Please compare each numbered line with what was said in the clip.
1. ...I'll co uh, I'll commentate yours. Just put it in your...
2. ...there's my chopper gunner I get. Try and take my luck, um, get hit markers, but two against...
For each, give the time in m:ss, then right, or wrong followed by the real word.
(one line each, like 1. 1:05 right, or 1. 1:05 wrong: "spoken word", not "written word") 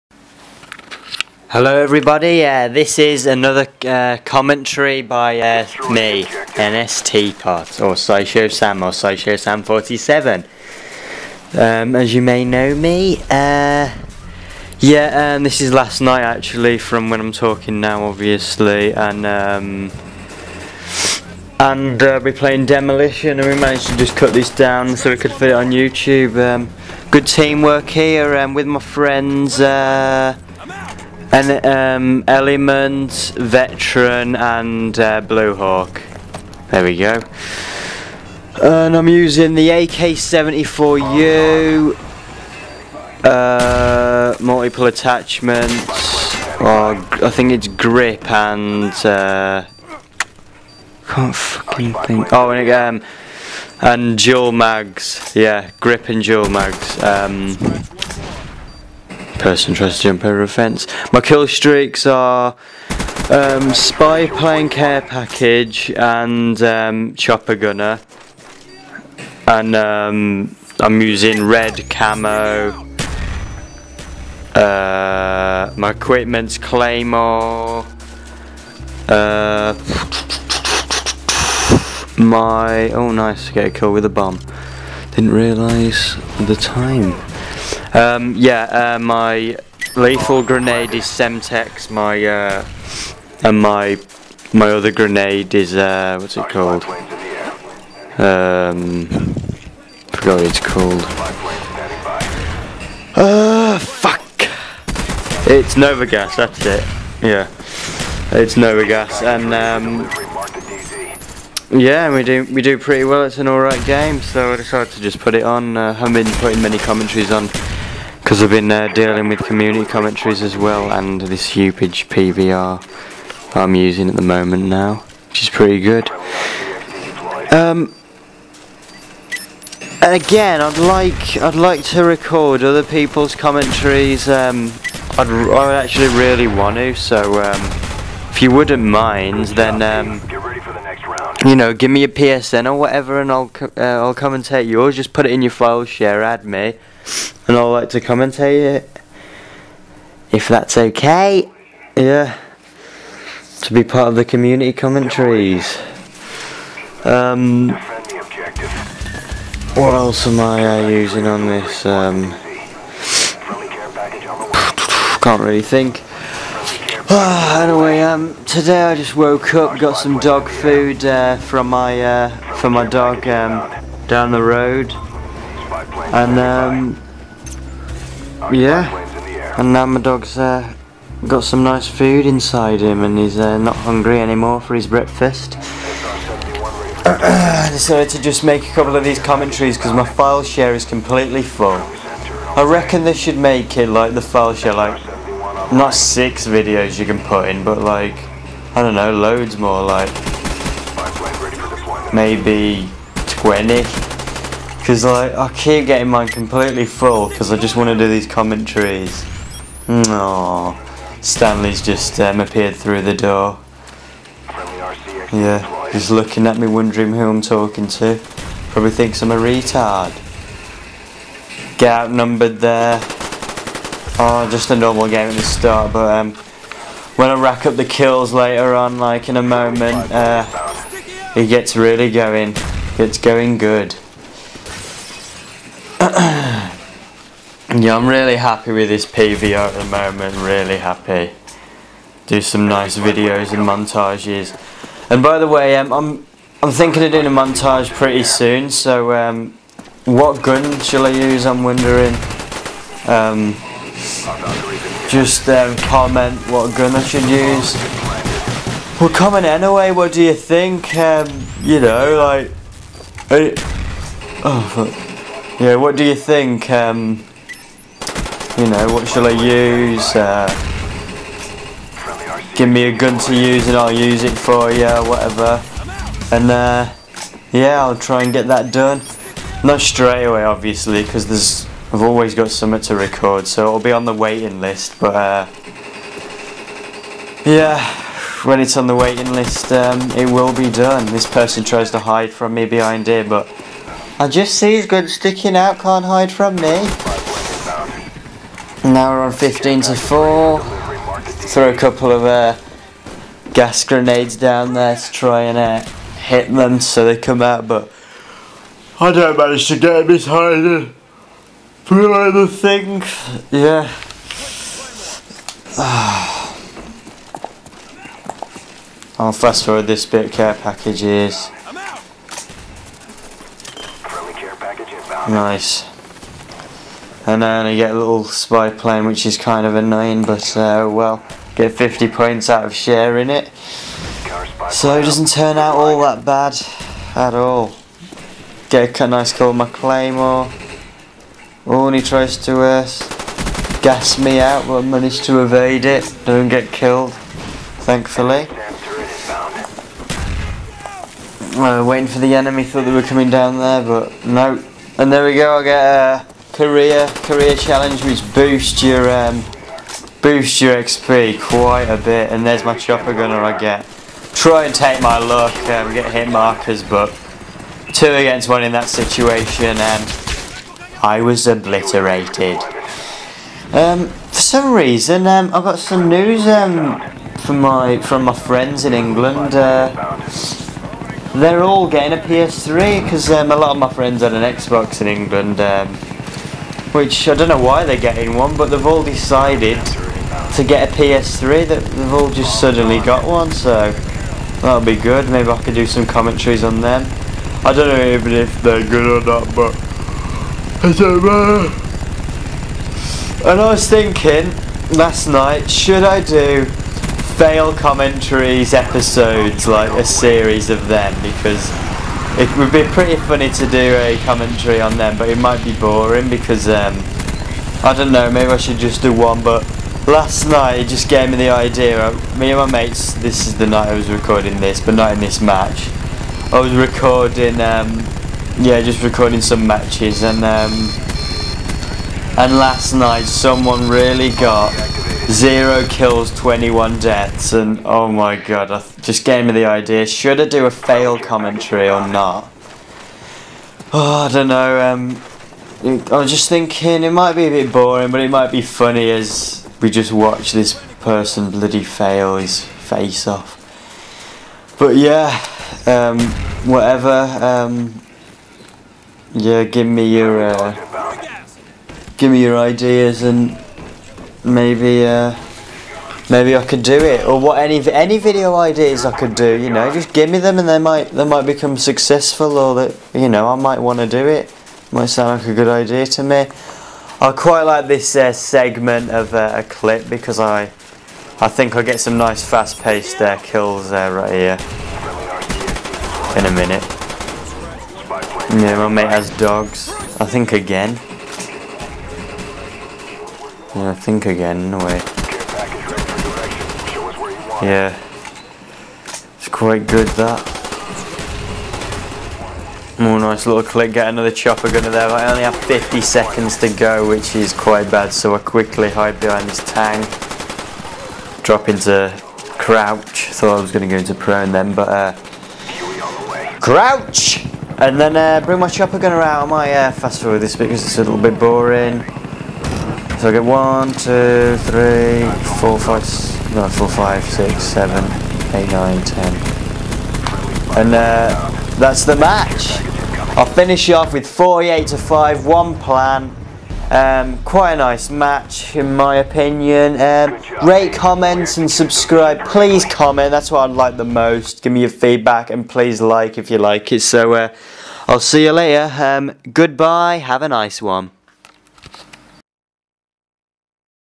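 1. 2:23 right
2. 6:02 right.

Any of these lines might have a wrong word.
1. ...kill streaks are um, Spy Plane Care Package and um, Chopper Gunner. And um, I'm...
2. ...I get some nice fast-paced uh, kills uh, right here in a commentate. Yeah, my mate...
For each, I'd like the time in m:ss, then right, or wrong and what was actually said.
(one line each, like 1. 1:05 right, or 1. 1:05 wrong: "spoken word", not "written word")
1. 1:01 right
2. 8:01 wrong: "minute", not "commentate".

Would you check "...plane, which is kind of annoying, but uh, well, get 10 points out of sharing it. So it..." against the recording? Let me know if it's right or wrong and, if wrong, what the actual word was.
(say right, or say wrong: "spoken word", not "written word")
wrong: "50", not "10".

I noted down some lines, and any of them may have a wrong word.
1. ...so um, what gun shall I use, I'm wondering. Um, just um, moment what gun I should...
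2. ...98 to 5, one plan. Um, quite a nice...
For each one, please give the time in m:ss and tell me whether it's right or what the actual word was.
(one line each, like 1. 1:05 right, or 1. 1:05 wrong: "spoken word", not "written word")
1. 4:08 wrong: "comment", not "moment"
2. 8:54 wrong: "48", not "98".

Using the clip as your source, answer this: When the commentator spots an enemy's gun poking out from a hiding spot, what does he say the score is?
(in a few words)
15 to 4.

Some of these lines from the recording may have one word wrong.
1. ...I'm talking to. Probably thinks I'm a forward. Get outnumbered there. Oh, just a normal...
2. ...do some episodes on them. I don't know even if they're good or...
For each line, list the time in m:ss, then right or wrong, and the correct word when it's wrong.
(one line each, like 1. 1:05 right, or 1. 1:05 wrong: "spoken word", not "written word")
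1. 3:37 wrong: "retard", not "forward"
2. 6:35 wrong: "commentaries", not "episodes".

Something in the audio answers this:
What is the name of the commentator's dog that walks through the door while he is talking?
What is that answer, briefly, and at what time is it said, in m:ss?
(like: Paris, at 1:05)
Stanley, at 3:31.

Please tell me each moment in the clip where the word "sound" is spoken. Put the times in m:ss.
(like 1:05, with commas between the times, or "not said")
7:55.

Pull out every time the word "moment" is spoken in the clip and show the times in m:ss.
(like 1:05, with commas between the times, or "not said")
2:04, 3:49, 3:59.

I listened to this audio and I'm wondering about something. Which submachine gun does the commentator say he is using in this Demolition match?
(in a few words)
AK-74U.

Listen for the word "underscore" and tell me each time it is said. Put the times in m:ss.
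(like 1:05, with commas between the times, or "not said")
not said.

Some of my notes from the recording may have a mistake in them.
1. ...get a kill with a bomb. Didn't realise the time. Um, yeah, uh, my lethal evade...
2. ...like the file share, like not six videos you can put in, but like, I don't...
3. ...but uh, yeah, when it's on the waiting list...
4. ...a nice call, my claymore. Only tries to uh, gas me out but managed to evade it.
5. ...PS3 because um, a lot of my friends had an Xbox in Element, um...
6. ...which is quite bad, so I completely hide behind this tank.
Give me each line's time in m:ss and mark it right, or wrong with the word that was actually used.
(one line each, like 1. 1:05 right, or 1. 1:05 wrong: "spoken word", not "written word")
1. 1:23 wrong: "grenade", not "evade"
2. 3:13 right
3. 4:45 right
4. 5:39 right
5. 6:22 wrong: "England", not "Element"
6. 8:27 wrong: "quickly", not "completely".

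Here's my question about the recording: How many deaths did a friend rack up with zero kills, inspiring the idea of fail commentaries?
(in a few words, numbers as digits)
21.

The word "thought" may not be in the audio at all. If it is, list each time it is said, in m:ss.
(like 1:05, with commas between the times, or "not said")
5:52, 8:33.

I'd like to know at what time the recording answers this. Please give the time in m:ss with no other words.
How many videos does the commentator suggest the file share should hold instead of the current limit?
3:23.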